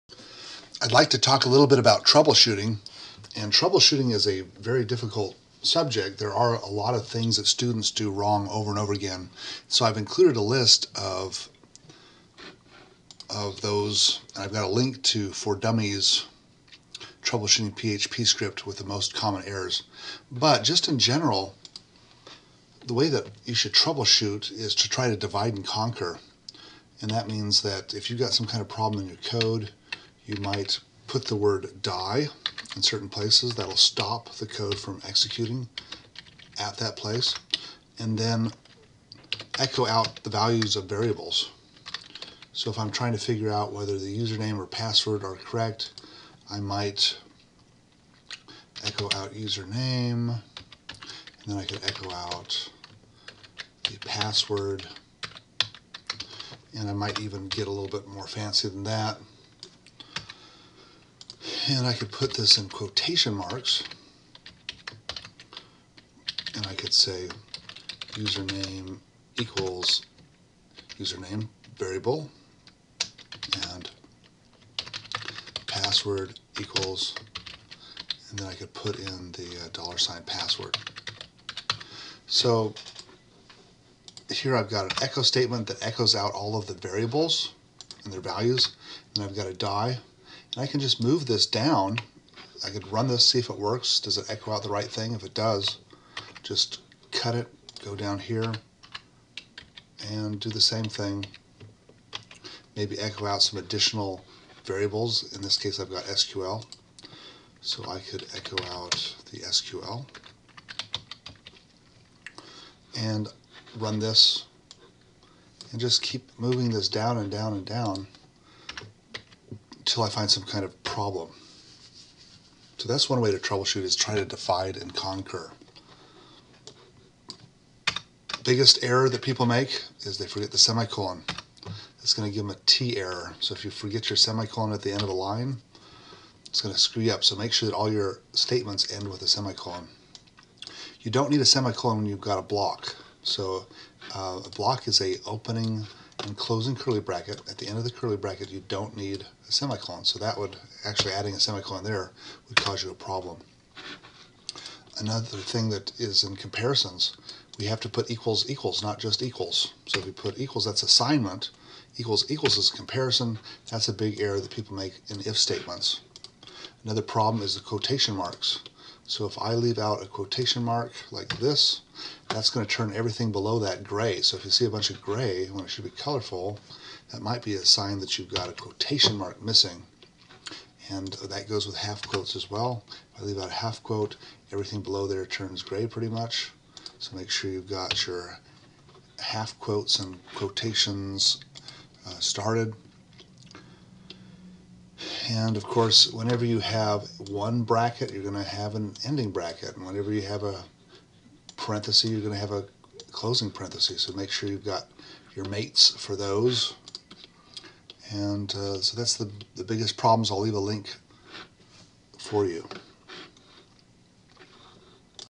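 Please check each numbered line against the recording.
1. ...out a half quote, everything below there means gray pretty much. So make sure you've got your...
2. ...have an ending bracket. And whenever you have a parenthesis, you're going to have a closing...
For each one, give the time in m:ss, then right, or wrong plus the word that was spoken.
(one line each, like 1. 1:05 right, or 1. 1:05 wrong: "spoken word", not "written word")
1. 3:03 wrong: "turns", not "means"
2. 3:18 right.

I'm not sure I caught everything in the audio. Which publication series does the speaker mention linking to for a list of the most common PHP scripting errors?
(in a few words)
For Dummies.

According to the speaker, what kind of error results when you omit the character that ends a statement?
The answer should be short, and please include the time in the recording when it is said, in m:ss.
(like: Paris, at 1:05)
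T error, at 2:12.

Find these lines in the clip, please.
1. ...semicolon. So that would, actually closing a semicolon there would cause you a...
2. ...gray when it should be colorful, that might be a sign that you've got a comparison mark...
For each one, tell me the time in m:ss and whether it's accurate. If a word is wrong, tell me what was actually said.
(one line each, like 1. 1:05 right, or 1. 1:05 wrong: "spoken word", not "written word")
1. 2:29 wrong: "adding", not "closing"
2. 2:55 wrong: "quotation", not "comparison".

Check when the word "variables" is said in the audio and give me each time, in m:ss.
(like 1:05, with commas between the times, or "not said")
0:40, 1:11, 1:26, 1:44.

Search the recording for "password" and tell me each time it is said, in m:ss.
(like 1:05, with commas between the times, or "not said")
0:44, 0:53, 1:15, 1:20.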